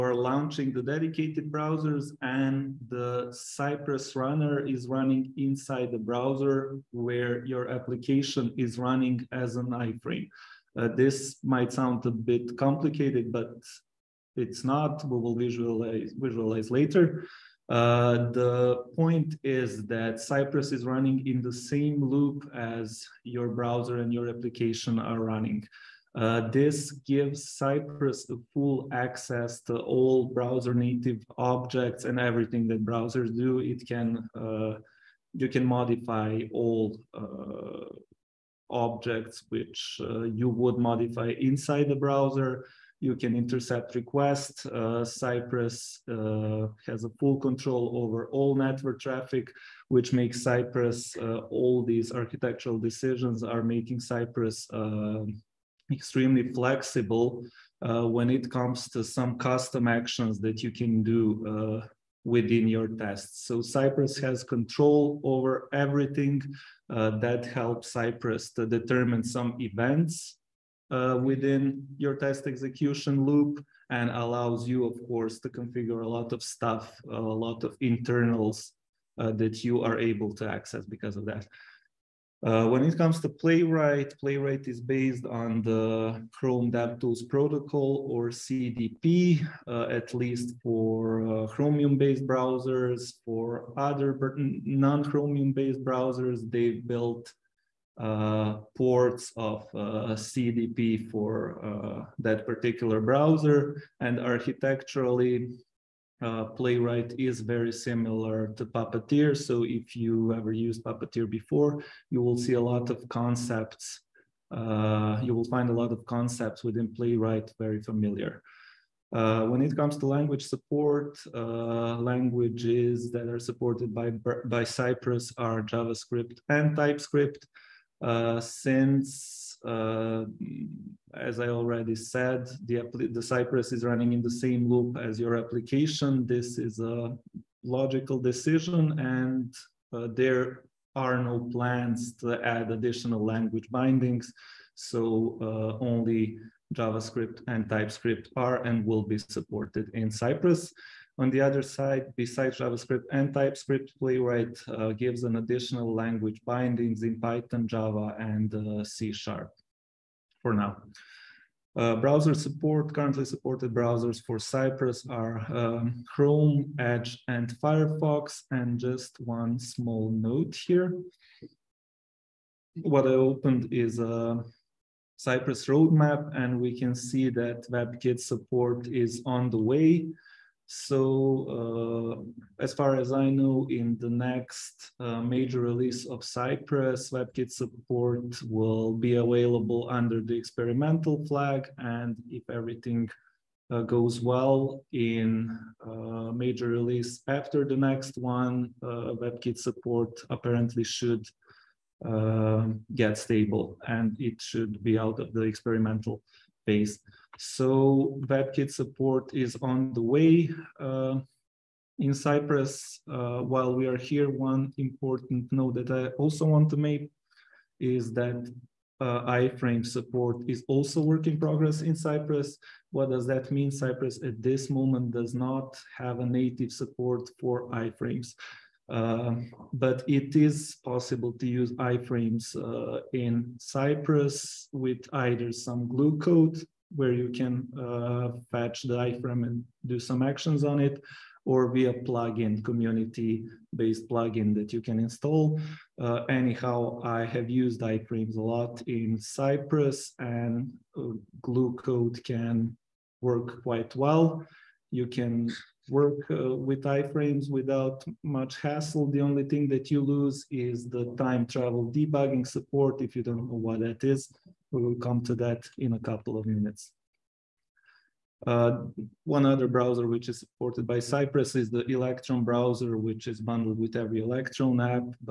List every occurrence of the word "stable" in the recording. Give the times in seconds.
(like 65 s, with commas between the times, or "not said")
203 s.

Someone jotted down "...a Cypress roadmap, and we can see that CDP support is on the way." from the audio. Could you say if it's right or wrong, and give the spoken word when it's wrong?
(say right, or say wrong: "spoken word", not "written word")
wrong: "WebKit", not "CDP".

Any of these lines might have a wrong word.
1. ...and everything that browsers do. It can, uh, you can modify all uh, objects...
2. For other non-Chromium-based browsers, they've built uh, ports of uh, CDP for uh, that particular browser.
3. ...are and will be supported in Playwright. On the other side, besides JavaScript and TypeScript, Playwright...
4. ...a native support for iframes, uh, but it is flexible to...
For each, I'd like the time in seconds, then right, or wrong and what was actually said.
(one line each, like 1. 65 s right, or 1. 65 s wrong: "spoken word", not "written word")
1. 32 s right
2. 93 s right
3. 148 s wrong: "Cypress", not "Playwright"
4. 226 s wrong: "possible", not "flexible".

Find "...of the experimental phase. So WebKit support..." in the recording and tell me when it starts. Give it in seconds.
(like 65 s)
205 s.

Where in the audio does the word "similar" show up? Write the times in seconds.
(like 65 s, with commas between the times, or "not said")
107 s.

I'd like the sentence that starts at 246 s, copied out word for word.
Uh, anyhow, I have used iframes a lot in Cypress and uh, glue code can work quite well.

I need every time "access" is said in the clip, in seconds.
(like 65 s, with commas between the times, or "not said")
28 s, 80 s.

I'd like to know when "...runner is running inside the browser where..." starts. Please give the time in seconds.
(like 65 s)
4 s.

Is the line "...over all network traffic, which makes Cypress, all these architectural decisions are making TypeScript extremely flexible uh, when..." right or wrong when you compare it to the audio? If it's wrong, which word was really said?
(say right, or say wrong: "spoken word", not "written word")
wrong: "Cypress", not "TypeScript".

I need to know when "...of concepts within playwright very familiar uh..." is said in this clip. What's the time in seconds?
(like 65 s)
115 s.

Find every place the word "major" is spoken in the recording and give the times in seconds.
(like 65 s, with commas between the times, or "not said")
185 s, 196 s.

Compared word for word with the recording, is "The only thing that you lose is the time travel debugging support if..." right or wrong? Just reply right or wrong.
right.